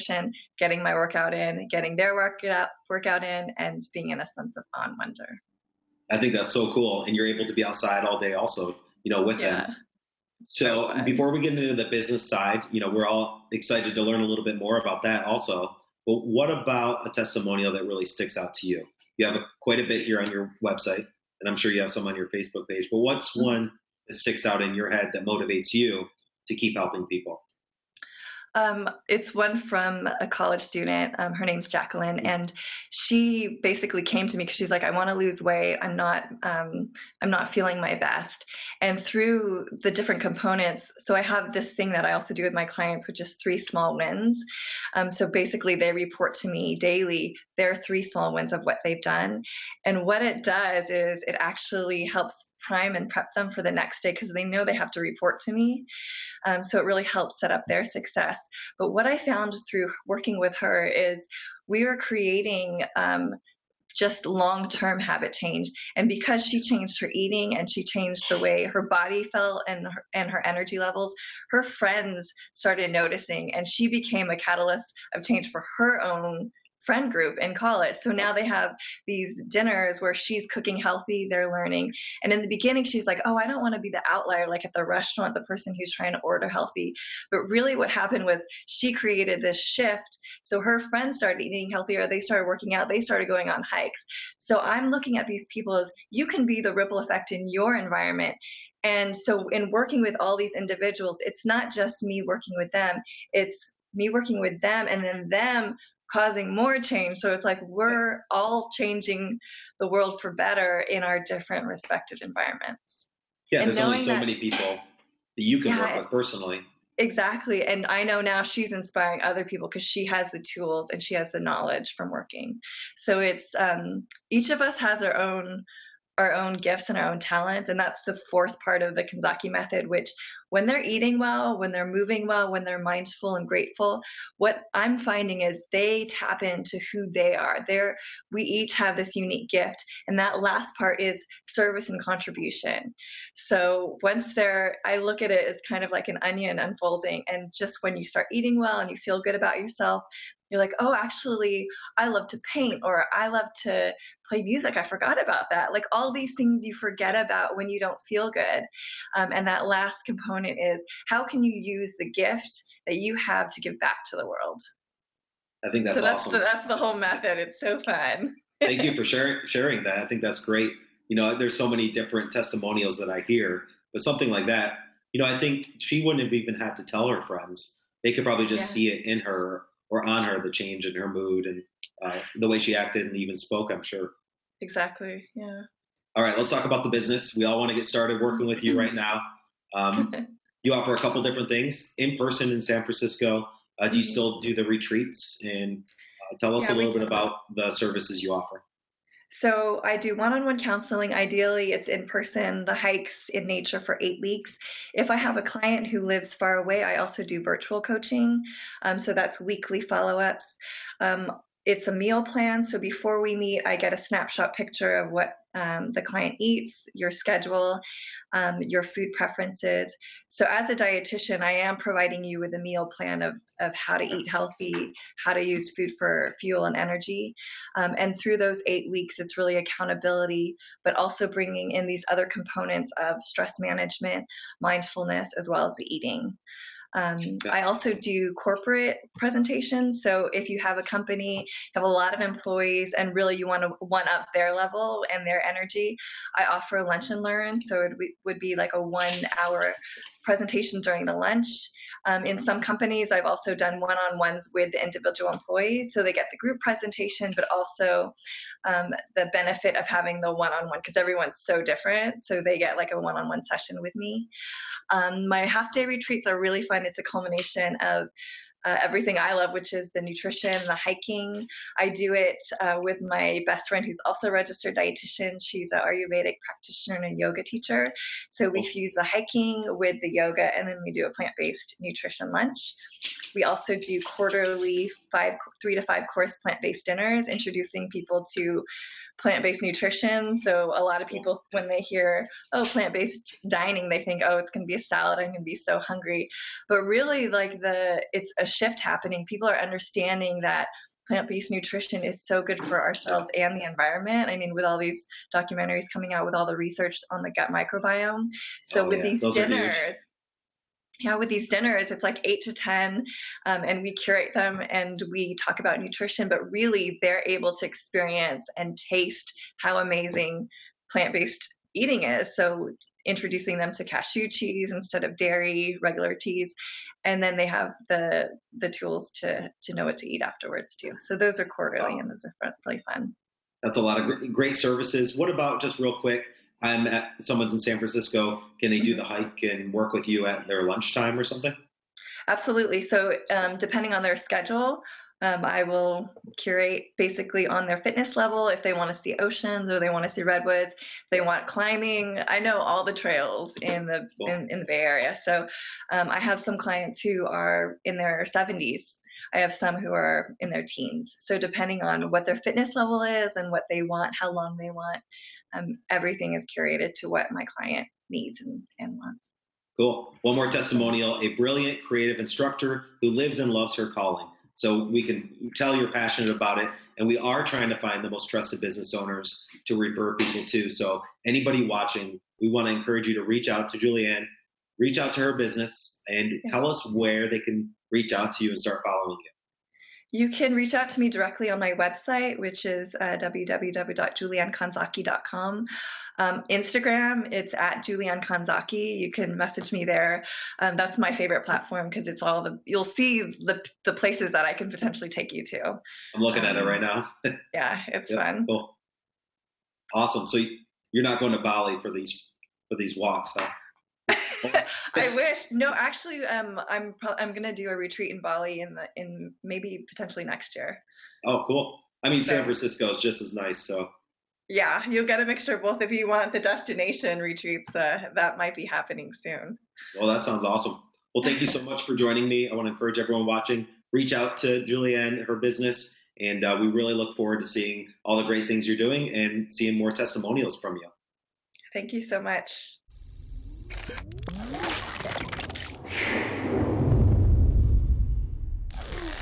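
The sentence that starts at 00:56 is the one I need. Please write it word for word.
Um, so it really helps set up their success.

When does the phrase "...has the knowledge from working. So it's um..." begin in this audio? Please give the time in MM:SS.
02:01.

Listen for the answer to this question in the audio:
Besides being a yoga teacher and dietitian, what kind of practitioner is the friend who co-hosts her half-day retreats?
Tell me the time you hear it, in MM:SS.
04:35.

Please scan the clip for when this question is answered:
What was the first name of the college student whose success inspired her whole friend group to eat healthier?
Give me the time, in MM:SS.
00:31.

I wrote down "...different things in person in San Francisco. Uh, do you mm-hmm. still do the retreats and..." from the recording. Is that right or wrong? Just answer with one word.
right.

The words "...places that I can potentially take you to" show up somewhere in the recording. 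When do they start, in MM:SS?
06:43.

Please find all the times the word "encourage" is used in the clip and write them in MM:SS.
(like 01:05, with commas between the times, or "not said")
06:22, 07:12.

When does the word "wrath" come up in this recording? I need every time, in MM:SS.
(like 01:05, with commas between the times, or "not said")
not said.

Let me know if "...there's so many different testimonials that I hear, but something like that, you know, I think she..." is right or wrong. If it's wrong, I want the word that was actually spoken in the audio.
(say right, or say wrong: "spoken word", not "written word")
right.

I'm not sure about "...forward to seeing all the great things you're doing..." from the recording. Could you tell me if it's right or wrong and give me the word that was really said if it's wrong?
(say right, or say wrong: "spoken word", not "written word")
right.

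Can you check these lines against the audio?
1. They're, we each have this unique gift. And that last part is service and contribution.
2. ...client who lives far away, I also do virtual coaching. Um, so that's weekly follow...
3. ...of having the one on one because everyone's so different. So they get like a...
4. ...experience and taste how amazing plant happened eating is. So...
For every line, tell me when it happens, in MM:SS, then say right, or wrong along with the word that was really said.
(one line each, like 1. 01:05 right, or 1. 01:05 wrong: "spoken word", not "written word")
1. 02:17 right
2. 03:25 right
3. 04:19 right
4. 05:17 wrong: "based", not "happened".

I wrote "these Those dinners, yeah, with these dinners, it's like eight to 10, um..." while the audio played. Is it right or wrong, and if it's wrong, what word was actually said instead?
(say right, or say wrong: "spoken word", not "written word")
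right.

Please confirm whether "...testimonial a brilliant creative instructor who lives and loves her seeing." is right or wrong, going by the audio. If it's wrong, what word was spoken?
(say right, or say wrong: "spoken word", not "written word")
wrong: "calling", not "seeing".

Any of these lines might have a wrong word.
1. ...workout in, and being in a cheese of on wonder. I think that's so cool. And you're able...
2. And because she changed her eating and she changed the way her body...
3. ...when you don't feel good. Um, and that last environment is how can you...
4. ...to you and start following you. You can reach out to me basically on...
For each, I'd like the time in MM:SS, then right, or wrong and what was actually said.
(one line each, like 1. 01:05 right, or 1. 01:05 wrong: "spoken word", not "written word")
1. 00:02 wrong: "sense", not "cheese"
2. 01:05 right
3. 02:37 wrong: "component", not "environment"
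4. 06:28 wrong: "directly", not "basically".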